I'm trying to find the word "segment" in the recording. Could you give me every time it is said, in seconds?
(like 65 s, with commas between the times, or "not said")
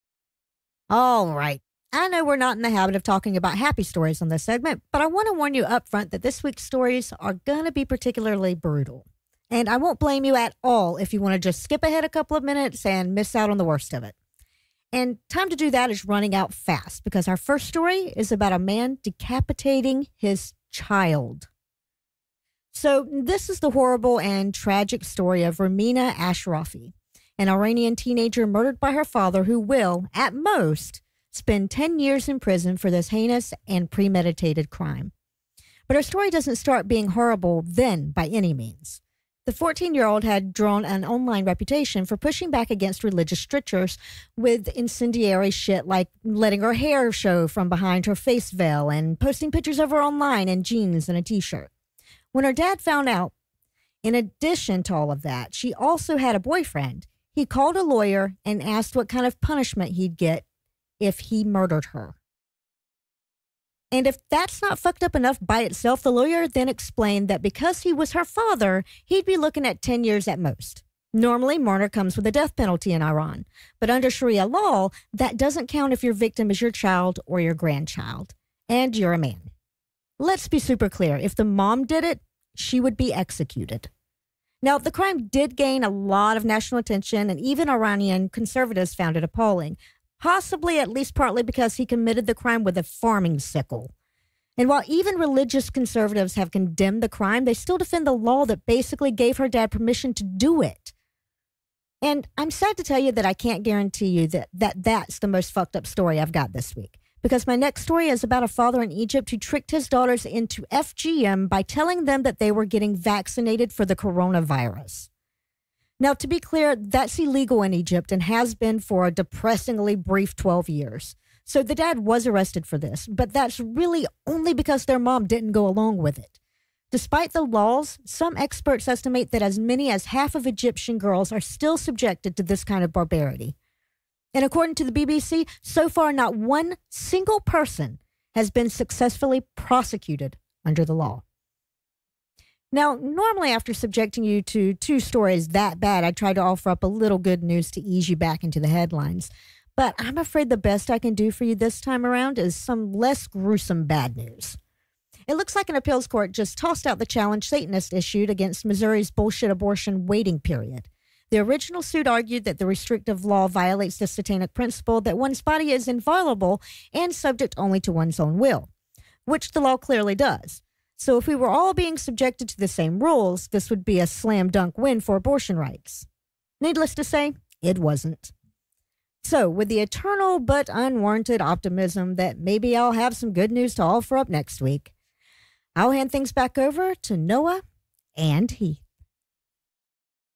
4 s.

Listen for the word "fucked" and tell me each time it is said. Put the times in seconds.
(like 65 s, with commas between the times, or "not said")
64 s, 105 s.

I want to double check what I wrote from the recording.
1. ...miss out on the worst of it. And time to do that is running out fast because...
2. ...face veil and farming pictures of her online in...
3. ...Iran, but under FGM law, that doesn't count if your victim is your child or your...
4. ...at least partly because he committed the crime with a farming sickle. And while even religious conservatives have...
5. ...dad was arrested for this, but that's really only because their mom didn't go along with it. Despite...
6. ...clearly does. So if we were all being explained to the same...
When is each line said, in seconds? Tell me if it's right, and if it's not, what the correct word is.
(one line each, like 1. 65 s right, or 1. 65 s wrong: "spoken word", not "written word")
1. 13 s right
2. 48 s wrong: "posting", not "farming"
3. 73 s wrong: "Sharia", not "FGM"
4. 90 s right
5. 121 s right
6. 169 s wrong: "subjected", not "explained".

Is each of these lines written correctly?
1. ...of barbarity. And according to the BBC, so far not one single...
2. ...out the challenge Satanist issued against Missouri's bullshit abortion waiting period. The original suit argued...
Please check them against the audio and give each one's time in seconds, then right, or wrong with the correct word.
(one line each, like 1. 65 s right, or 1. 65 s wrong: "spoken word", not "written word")
1. 132 s right
2. 156 s right.